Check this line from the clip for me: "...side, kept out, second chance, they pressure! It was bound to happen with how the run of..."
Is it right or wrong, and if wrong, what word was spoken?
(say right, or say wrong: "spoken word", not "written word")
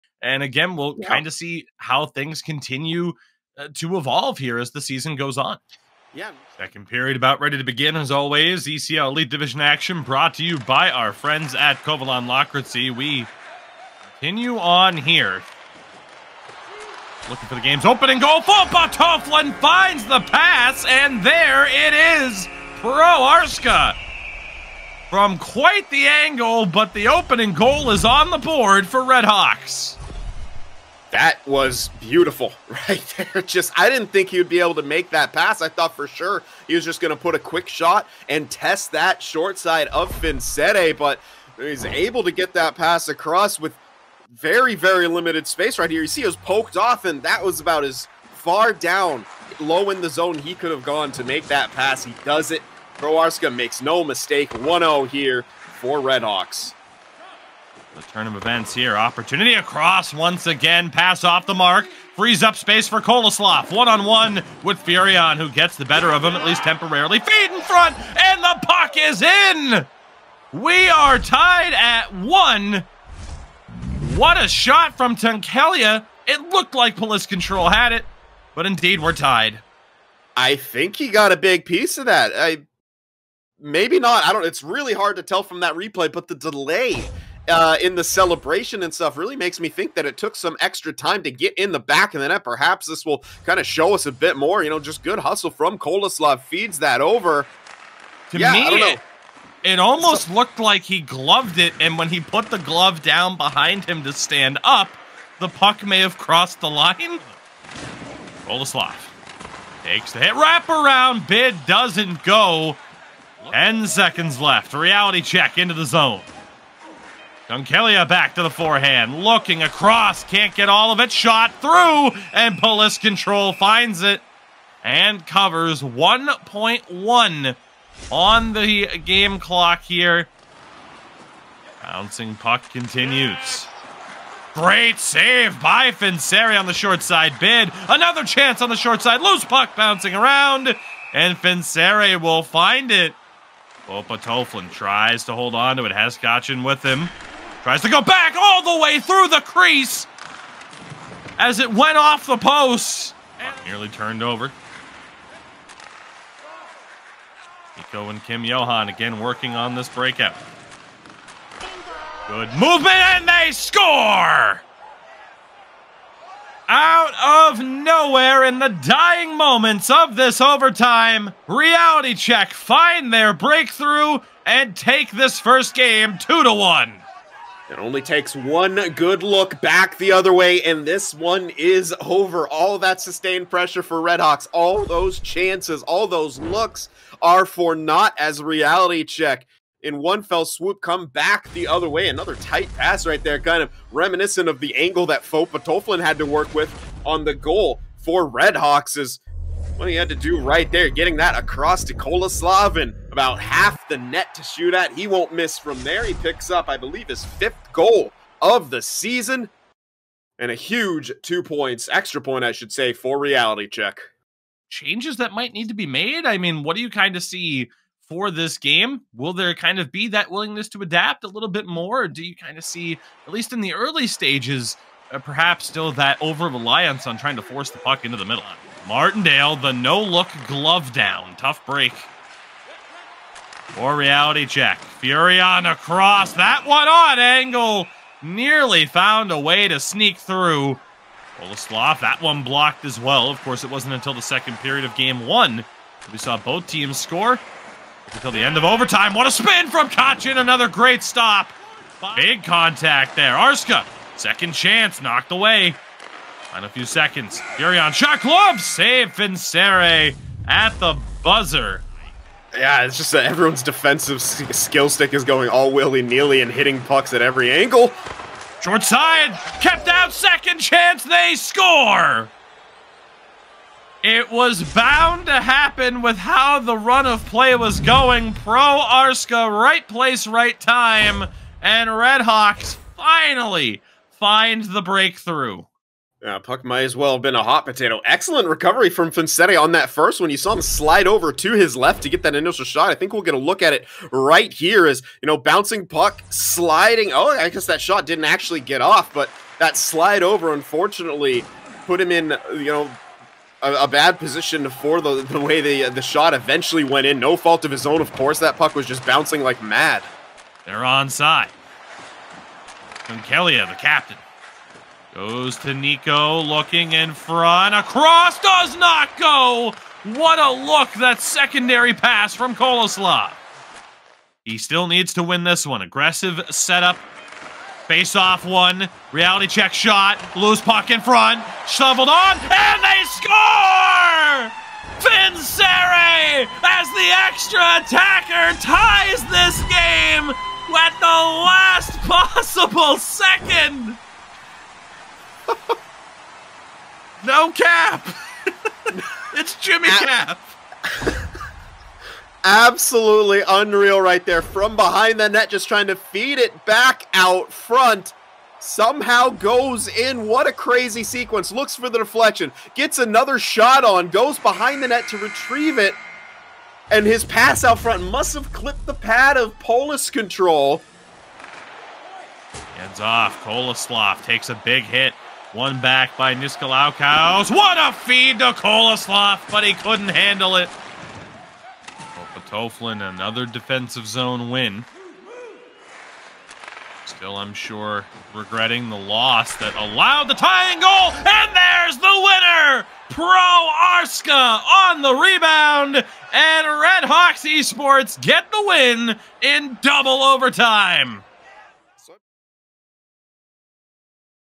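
wrong: "score", not "pressure".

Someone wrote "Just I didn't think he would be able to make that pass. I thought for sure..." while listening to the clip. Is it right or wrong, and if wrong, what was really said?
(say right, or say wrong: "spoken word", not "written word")
right.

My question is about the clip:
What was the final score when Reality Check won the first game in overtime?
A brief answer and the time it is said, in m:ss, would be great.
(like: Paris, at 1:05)
2 to 1, at 2:56.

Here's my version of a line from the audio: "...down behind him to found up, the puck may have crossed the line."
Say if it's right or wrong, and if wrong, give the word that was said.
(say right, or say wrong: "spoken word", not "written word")
wrong: "stand", not "found".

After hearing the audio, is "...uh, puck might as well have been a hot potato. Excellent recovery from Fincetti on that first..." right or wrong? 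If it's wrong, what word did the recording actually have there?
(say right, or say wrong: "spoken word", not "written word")
right.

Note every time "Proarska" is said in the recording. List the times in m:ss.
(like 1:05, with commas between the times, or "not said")
0:52.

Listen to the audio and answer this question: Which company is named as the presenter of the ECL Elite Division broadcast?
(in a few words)
Kovalon Locracy.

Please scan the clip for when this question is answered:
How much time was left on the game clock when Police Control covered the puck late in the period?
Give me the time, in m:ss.
2:05.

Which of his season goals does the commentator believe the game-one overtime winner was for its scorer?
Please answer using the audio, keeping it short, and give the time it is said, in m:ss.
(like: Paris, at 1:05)
his fifth goal, at 3:27.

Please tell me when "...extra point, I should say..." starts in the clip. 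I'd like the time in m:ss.
3:31.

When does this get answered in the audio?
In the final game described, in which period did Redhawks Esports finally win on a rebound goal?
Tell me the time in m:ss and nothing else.
6:39.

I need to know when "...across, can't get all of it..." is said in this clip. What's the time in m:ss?
1:59.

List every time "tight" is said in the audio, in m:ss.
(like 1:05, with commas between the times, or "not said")
3:12.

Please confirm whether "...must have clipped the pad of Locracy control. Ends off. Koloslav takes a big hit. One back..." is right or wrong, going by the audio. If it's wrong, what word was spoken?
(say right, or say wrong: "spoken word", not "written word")
wrong: "Polis", not "Locracy".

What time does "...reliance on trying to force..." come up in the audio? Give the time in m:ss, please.
3:46.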